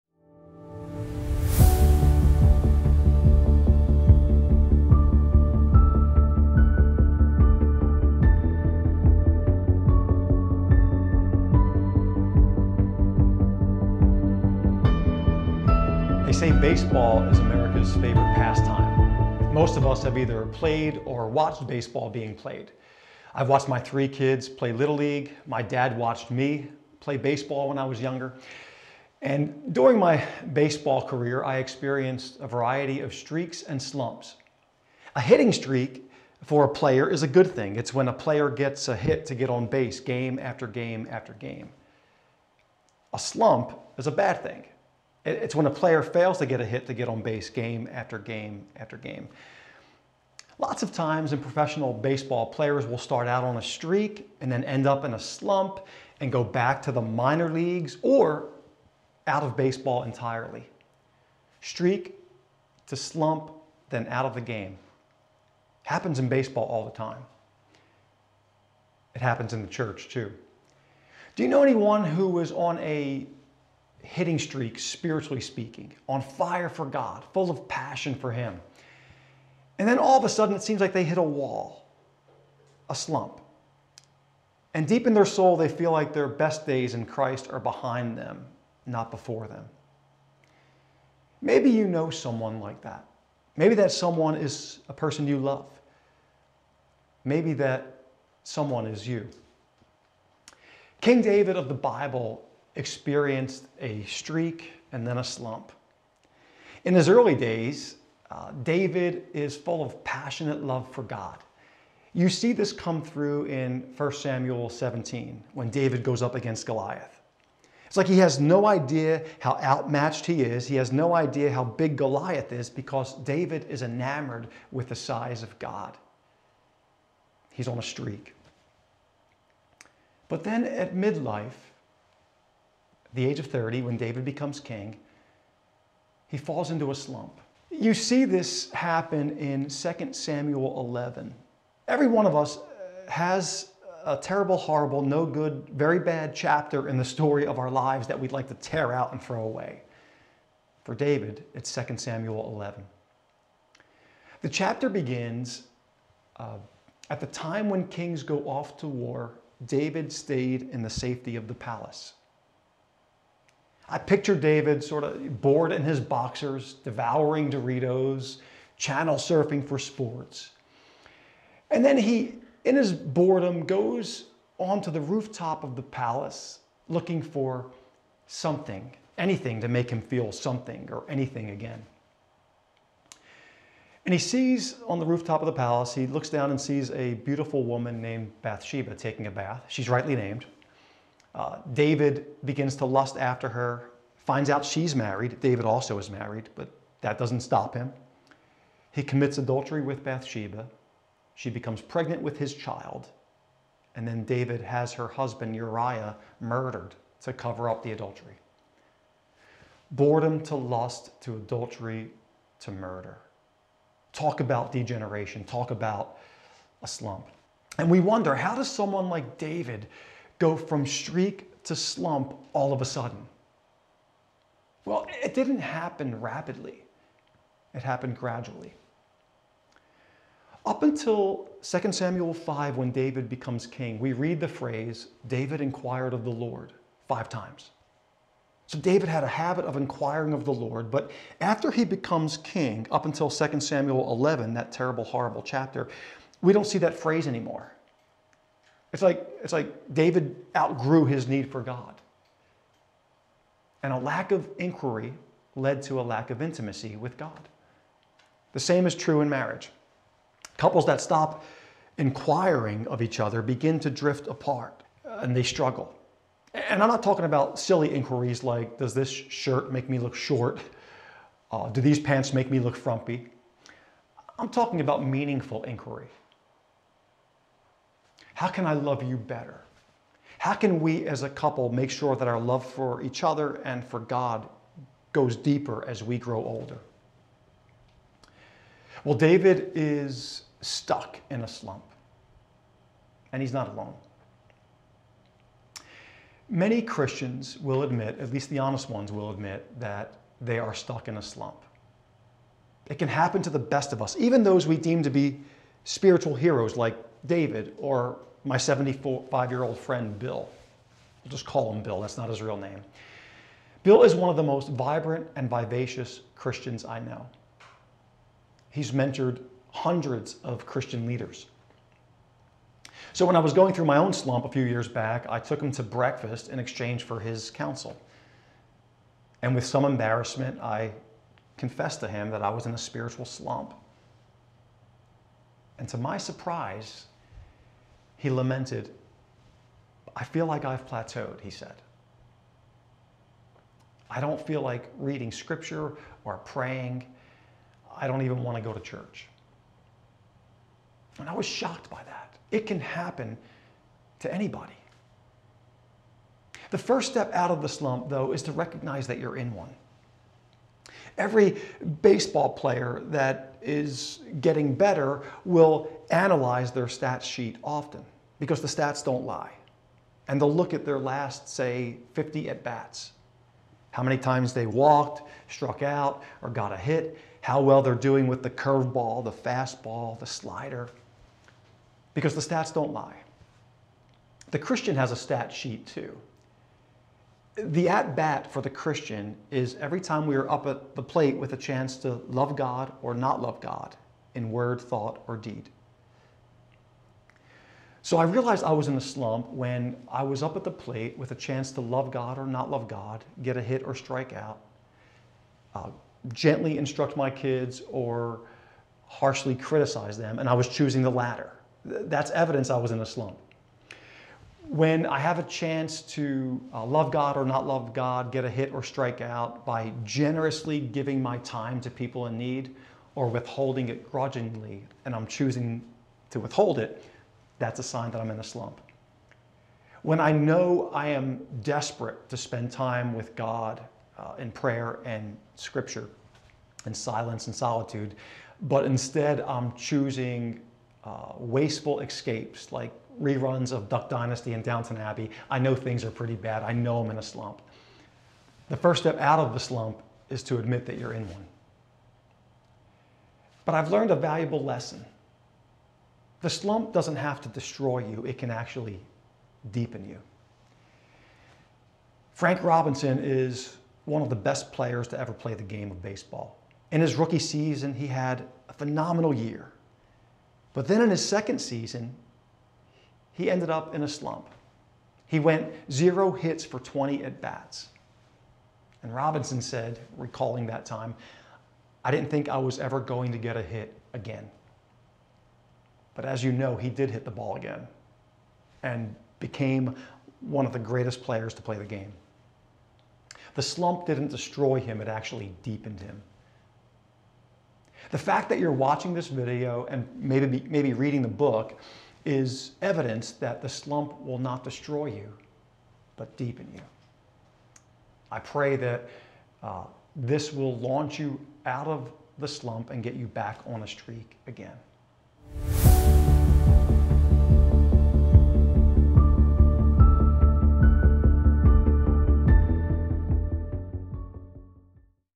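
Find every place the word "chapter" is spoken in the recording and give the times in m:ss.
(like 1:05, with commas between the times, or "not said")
2:26, 2:34, 4:05.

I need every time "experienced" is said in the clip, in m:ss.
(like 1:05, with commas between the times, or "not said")
0:31, 1:42.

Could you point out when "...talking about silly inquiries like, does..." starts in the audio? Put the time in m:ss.
4:27.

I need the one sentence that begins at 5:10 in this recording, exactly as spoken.
i will just call him Bill, that's not his real name.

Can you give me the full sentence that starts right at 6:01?
Every baseball player that is getting better will analyze their stats sheet often because the stats don't lie.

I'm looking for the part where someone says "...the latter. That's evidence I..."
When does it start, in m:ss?
6:51.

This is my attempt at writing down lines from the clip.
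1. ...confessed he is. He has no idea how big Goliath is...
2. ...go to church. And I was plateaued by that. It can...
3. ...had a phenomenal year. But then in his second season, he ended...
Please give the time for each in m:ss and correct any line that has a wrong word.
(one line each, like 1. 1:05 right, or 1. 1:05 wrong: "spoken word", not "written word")
1. 1:59 wrong: "outmatched", not "confessed"
2. 5:48 wrong: "shocked", not "plateaued"
3. 7:48 right.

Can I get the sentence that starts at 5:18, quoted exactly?
He's mentored hundreds of Christian leaders.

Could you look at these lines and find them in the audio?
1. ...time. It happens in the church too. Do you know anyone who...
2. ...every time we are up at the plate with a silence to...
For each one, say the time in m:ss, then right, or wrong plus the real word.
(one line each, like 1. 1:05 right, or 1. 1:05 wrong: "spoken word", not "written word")
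1. 1:06 right
2. 6:29 wrong: "chance", not "silence".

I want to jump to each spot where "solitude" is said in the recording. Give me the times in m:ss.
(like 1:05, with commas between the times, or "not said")
7:17.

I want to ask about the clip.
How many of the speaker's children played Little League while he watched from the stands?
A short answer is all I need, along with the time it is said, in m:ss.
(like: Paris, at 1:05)
3, at 0:23.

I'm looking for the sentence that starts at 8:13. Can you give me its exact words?
The slump didn't destroy him, it actually deepened him.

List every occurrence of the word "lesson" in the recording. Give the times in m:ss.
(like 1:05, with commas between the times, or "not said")
7:34.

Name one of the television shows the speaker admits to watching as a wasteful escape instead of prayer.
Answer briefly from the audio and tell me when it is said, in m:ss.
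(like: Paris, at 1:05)
Duck Dynasty, at 7:23.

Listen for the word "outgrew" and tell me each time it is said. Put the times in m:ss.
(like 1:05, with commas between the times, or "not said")
4:10.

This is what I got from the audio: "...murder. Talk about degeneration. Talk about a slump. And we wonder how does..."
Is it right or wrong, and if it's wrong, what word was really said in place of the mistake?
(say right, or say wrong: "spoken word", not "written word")
right.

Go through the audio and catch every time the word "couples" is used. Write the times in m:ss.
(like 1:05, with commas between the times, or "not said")
4:20, 4:41.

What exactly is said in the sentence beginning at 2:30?
For David, it's 2 Samuel 11.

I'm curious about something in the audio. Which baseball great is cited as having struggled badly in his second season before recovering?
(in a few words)
Frank Robinson.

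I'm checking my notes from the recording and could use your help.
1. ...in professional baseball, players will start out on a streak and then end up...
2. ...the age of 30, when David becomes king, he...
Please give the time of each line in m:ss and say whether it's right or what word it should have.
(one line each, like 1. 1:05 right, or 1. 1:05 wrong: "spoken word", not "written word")
1. 0:51 right
2. 2:13 right.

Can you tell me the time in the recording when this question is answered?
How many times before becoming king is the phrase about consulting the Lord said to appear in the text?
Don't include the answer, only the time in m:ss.
3:57.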